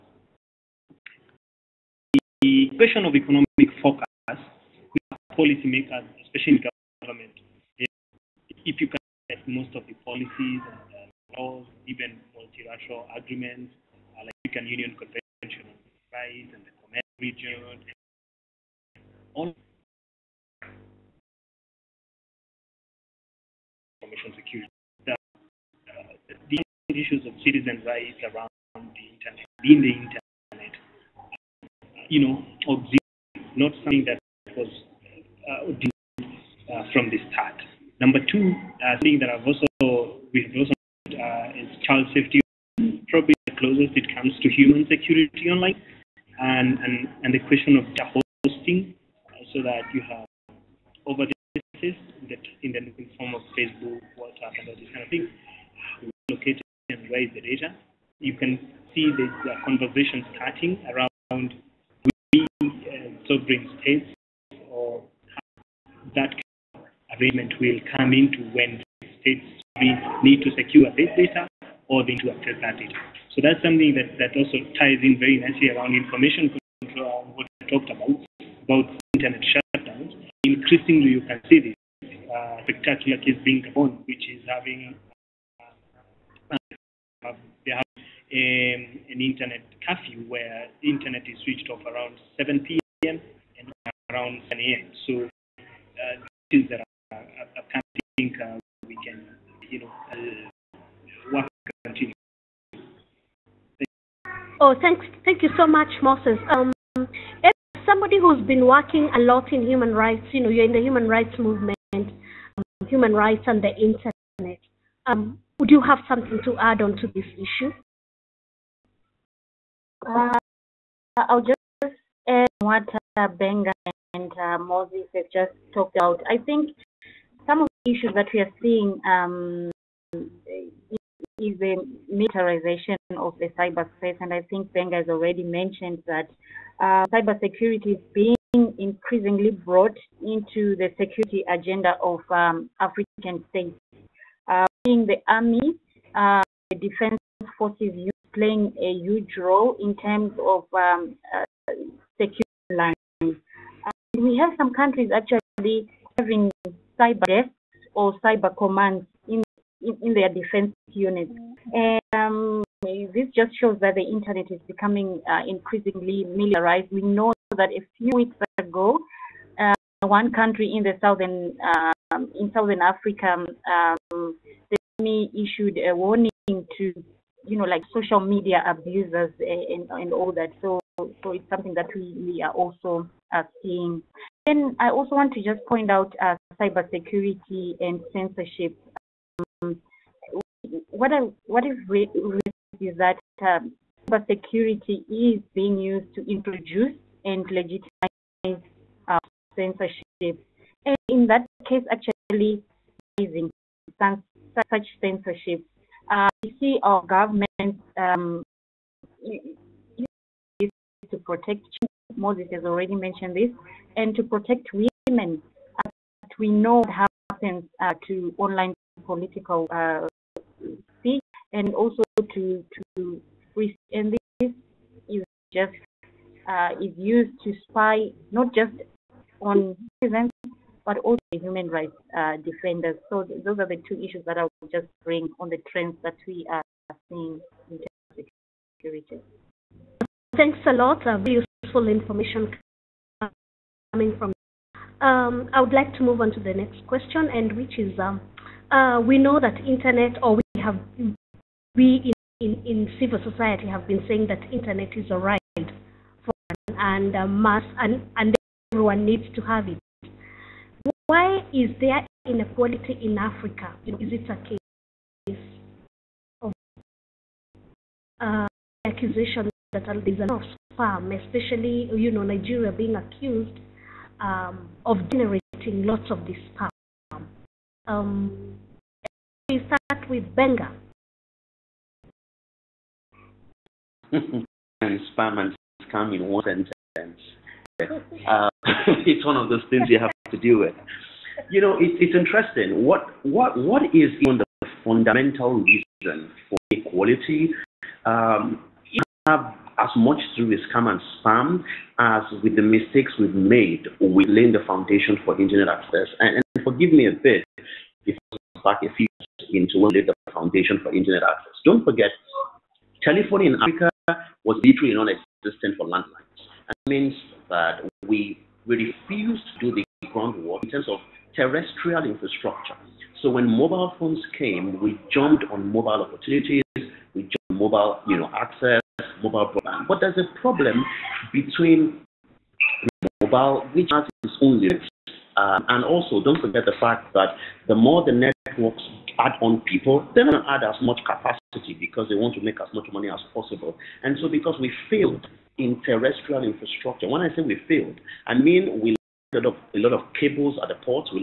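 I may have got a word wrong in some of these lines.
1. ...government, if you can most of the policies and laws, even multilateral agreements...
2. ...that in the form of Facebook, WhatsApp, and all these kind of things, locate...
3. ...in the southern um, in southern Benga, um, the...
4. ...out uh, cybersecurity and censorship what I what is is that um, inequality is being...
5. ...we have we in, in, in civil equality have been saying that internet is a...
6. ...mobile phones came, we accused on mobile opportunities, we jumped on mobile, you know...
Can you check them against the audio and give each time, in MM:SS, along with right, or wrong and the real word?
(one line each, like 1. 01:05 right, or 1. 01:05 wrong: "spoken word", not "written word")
1. 00:07 right
2. 00:51 right
3. 02:50 wrong: "Africa", not "Benga"
4. 03:05 wrong: "security", not "inequality"
5. 04:10 wrong: "society", not "equality"
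6. 05:23 wrong: "jumped", not "accused".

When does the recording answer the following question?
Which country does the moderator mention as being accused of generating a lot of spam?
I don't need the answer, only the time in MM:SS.
04:32.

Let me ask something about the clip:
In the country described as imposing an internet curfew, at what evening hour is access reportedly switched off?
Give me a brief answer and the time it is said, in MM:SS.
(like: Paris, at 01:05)
7 p.m., at 01:32.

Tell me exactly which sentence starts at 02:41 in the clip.
And um, this just shows that the internet is becoming uh, increasingly militarized.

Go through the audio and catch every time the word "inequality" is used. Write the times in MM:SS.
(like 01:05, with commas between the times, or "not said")
04:22.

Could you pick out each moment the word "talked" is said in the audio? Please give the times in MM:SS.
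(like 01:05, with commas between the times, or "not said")
01:17, 02:05.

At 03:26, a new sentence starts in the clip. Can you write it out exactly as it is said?
Uh, we see our government um, to protect.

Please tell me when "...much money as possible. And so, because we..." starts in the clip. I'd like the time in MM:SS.
05:42.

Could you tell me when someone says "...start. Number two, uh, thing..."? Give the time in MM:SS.
00:37.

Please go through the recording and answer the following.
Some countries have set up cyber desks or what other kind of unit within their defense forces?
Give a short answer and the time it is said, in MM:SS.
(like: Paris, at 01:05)
cyber commands, at 02:38.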